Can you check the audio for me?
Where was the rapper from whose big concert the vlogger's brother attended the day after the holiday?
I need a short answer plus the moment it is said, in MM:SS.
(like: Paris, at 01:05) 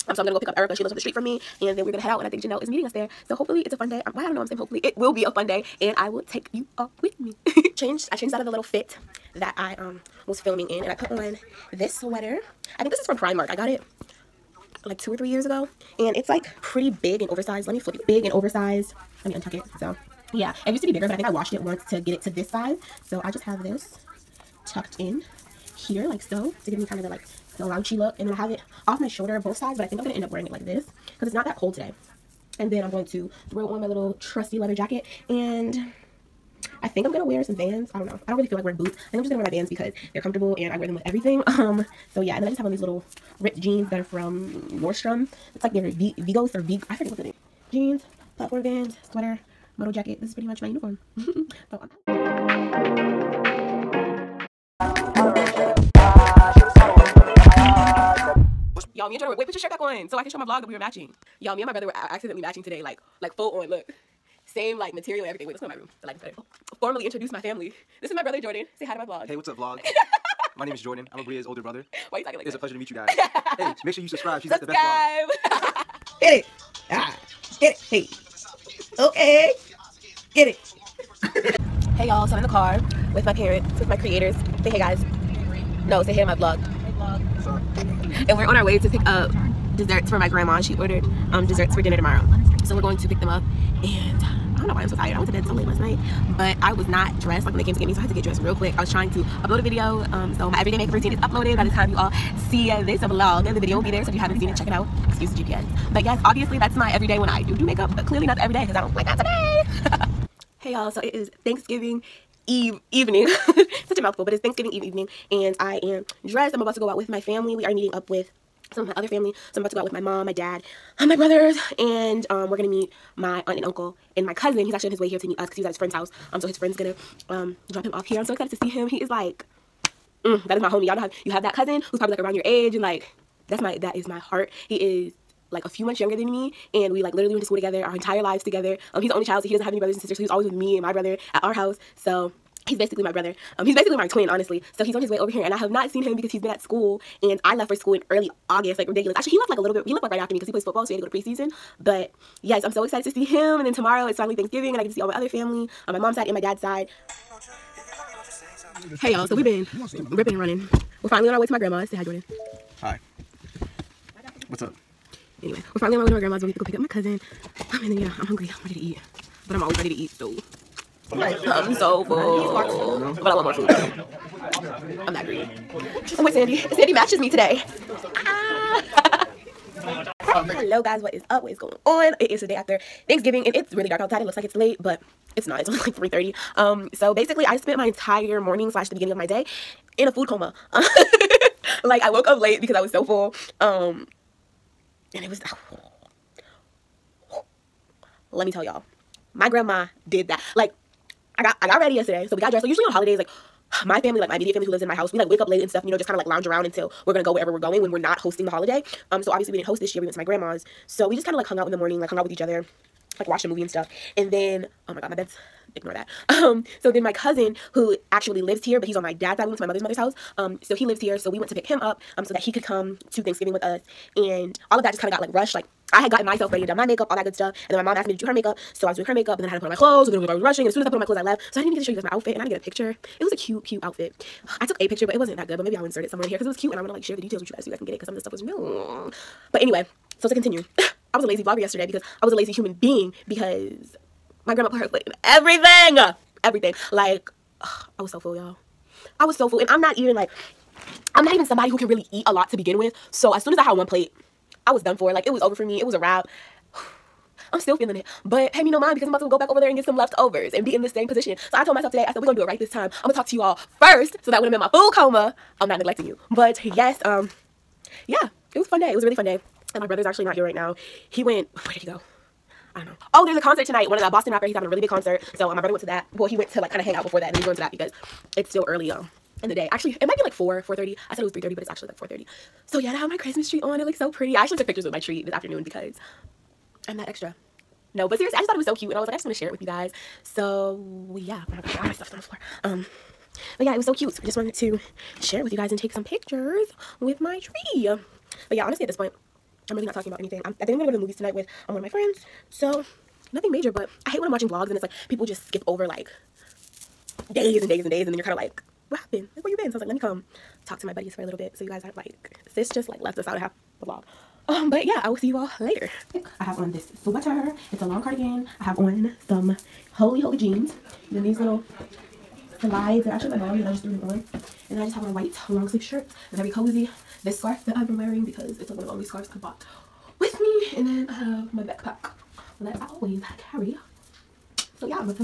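Boston, at 04:34.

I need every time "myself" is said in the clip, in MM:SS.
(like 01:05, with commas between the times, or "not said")
03:46, 04:21.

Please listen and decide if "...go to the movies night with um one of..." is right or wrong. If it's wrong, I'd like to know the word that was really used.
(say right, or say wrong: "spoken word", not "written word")
wrong: "tonight", not "night".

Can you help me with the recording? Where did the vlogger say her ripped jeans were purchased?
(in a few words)
Nordstrom.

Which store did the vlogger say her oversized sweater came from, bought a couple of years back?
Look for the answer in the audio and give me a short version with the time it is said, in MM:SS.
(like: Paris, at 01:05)
Primark, at 00:13.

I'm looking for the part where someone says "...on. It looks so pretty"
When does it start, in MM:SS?
04:43.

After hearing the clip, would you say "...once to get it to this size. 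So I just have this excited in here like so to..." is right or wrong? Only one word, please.
wrong.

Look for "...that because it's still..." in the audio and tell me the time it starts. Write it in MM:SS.
04:37.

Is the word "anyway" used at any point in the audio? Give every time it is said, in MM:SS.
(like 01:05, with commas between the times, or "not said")
02:45, 03:59.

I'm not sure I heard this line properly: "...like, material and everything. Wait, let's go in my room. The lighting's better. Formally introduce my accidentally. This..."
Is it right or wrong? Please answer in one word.
wrong.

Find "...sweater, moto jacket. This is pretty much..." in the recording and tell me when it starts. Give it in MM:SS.
00:49.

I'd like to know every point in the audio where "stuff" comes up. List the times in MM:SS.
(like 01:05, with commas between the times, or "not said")
03:25, 03:33, 03:47, 03:58, 04:51.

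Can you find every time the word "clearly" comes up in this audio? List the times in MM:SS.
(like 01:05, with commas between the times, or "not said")
01:48.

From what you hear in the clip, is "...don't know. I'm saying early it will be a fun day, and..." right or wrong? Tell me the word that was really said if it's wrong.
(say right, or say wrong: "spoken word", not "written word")
wrong: "hopefully", not "early".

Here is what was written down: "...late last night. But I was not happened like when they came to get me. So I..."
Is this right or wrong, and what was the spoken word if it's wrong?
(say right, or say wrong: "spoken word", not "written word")
wrong: "dressed", not "happened".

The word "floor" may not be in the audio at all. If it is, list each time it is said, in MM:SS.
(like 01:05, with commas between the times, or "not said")
04:52.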